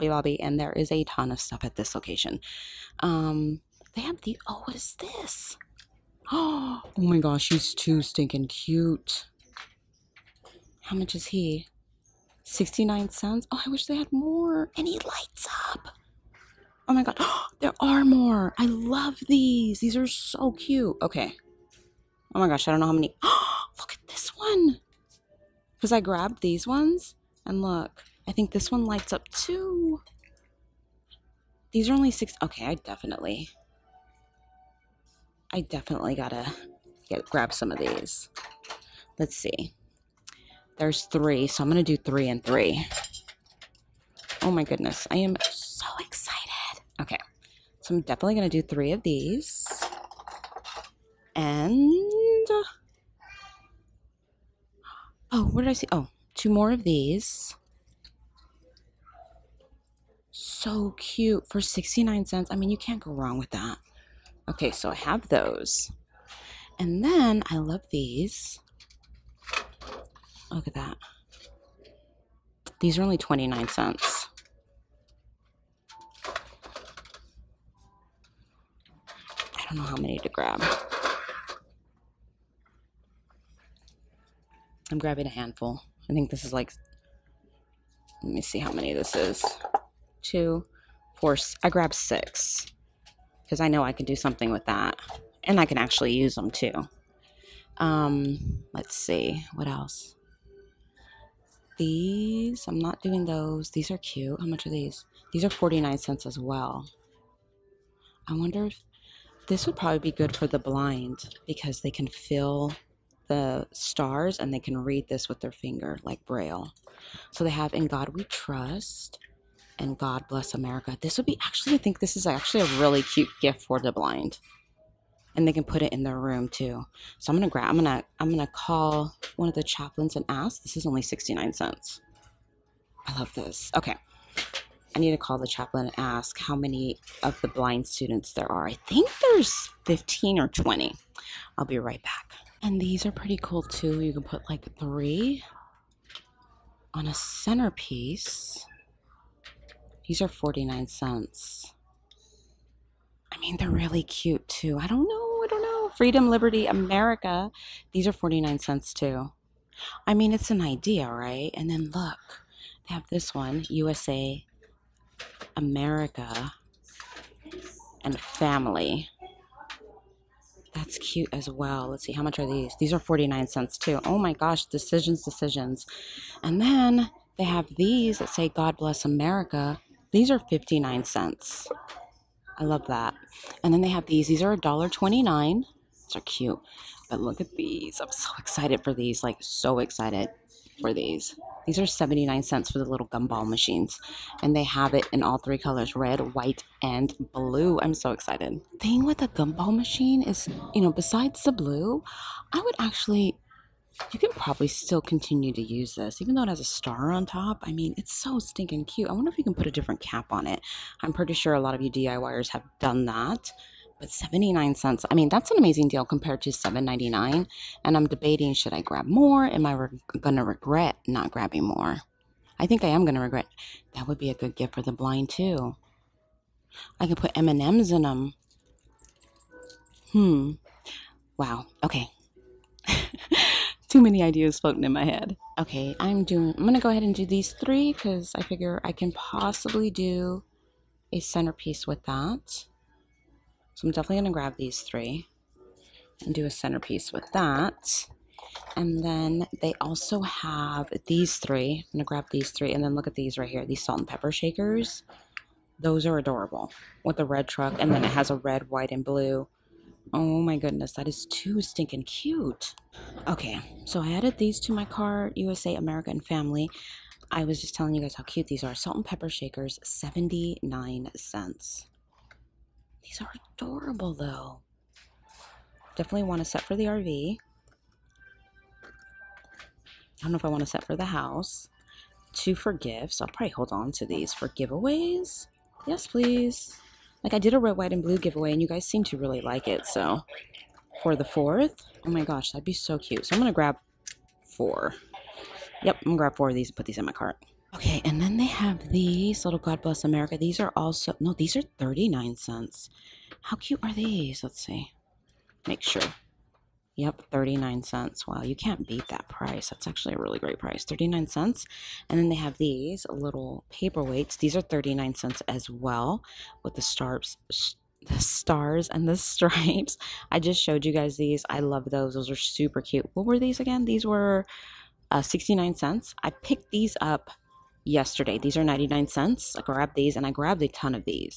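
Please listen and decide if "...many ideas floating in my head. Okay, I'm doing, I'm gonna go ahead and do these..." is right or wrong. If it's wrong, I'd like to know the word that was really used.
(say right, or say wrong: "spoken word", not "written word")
right.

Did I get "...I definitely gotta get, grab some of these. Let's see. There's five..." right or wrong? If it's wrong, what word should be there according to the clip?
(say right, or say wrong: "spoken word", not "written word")
wrong: "three", not "five".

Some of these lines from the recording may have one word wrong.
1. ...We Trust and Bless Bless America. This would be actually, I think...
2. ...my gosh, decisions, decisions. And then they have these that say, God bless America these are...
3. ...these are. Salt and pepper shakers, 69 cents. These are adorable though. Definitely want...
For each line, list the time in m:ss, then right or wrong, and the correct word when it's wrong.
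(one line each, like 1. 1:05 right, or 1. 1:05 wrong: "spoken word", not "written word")
1. 1:58 wrong: "God", not "Bless"
2. 2:54 right
3. 4:28 wrong: "79", not "69".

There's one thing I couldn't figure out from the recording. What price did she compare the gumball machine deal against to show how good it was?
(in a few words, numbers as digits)
7.99.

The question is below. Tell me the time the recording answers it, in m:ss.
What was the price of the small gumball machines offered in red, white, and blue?
3:11.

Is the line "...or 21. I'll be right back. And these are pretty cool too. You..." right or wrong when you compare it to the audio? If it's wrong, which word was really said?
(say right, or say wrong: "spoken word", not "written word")
wrong: "20", not "21".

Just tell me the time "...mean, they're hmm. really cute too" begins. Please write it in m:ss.
2:33.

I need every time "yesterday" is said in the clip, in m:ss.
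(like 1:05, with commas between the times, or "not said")
5:27.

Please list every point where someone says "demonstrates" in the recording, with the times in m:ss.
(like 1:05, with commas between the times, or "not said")
not said.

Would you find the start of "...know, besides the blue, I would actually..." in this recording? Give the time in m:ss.
3:20.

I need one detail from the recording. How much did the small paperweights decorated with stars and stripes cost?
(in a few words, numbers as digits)
39 cents.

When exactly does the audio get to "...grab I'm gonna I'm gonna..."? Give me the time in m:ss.
2:07.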